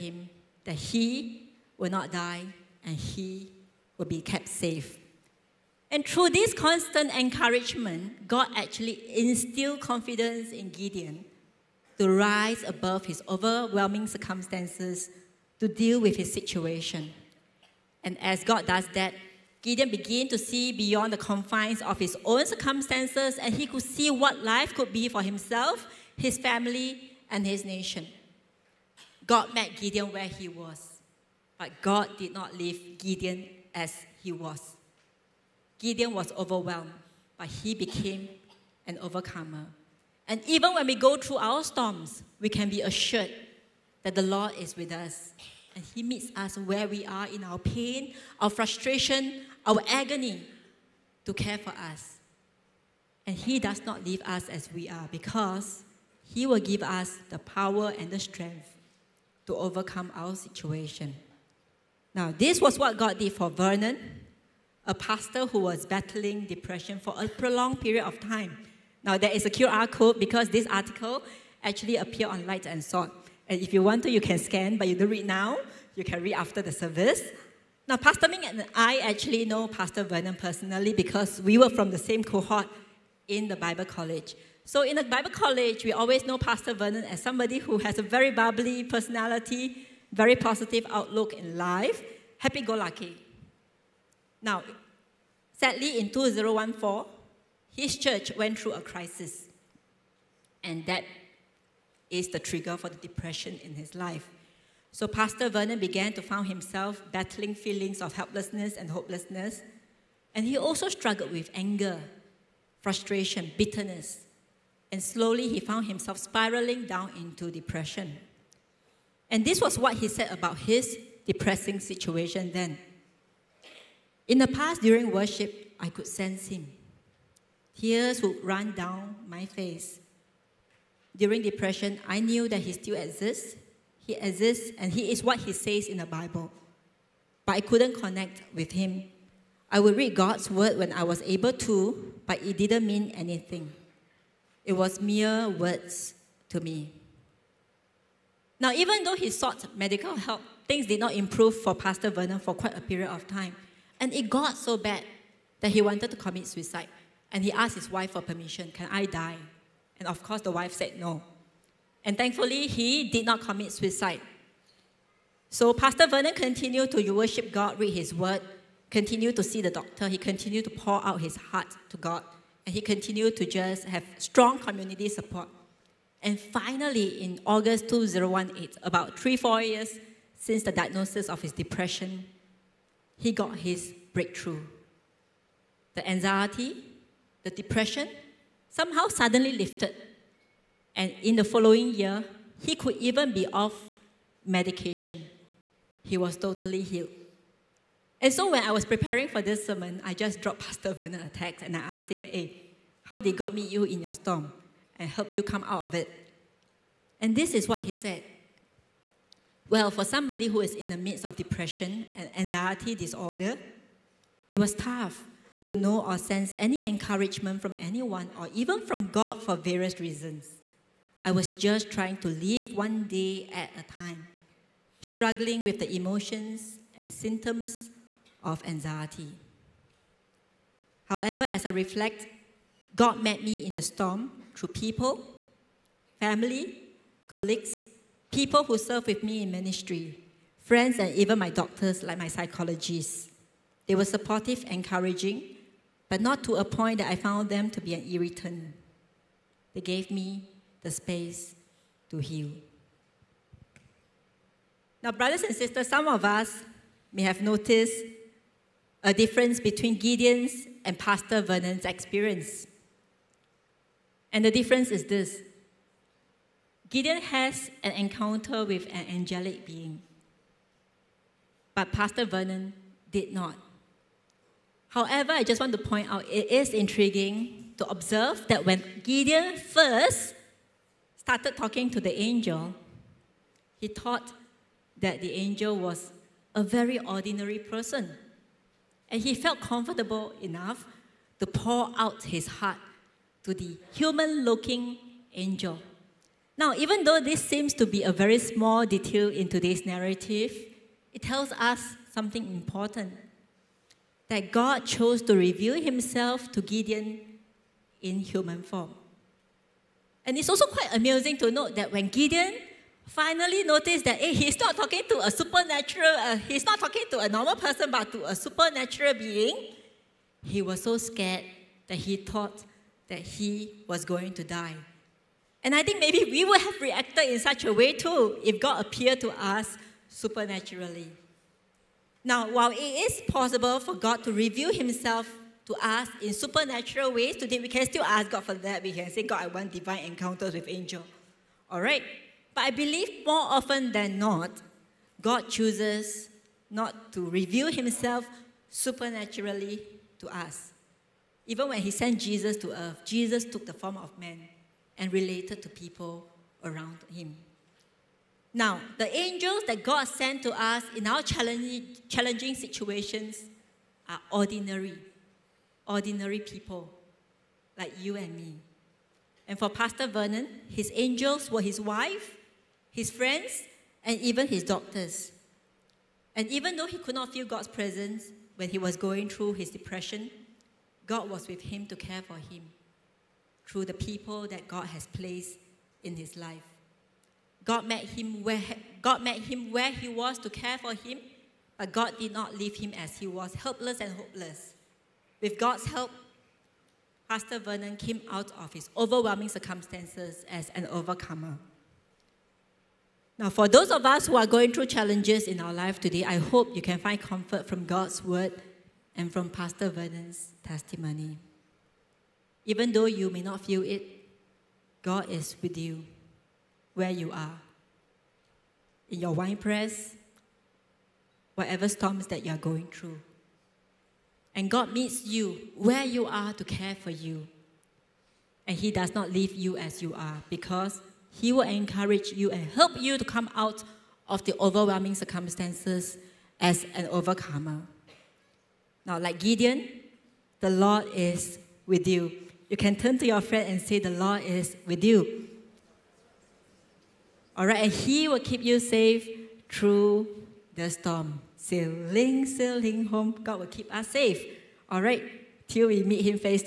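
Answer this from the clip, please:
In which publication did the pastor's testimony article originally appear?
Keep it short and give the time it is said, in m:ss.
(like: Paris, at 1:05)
Light and Salt, at 1:12.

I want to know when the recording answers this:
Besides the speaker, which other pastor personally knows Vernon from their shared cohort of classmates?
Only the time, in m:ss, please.
1:17.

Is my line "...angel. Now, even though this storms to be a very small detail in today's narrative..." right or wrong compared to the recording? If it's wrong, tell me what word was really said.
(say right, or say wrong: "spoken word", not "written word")
wrong: "seems", not "storms".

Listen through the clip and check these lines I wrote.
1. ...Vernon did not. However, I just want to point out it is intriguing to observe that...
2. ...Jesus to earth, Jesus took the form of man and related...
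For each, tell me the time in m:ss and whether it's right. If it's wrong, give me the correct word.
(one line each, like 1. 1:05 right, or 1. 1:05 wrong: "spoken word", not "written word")
1. 4:32 right
2. 5:52 right.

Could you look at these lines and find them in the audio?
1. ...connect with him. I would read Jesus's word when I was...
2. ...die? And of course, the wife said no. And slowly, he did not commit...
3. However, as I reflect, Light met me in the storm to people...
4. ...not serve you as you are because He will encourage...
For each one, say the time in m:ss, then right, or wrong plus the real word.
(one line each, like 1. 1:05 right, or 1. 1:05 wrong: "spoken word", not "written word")
1. 2:17 wrong: "God", not "Jesus"
2. 2:39 wrong: "thankfully", not "slowly"
3. 3:51 wrong: "God", not "Light"
4. 7:09 wrong: "leave", not "serve".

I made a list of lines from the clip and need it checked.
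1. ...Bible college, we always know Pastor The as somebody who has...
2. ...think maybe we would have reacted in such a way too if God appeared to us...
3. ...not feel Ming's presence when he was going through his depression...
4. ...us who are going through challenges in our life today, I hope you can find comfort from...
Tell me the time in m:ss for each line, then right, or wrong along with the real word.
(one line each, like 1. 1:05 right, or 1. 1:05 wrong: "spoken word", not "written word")
1. 1:25 wrong: "Vernon", not "The"
2. 5:25 right
3. 6:17 wrong: "God", not "Ming"
4. 6:44 right.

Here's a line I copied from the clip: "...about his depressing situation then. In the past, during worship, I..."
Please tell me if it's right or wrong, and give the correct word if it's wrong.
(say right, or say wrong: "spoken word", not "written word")
right.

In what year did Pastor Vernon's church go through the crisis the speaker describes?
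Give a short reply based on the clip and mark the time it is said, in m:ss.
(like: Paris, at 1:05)
2014, at 1:36.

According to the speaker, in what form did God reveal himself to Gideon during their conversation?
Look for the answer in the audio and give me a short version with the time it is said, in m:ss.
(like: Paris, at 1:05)
Human form, at 5:08.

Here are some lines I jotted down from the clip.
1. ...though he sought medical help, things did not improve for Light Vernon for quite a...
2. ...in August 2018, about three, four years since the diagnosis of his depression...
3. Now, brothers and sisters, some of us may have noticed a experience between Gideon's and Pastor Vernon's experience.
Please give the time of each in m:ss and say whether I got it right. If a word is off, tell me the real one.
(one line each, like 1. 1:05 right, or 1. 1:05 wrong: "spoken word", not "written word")
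1. 2:29 wrong: "Pastor", not "Light"
2. 2:57 right
3. 4:15 wrong: "difference", not "experience".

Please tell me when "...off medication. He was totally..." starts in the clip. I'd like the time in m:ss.
3:13.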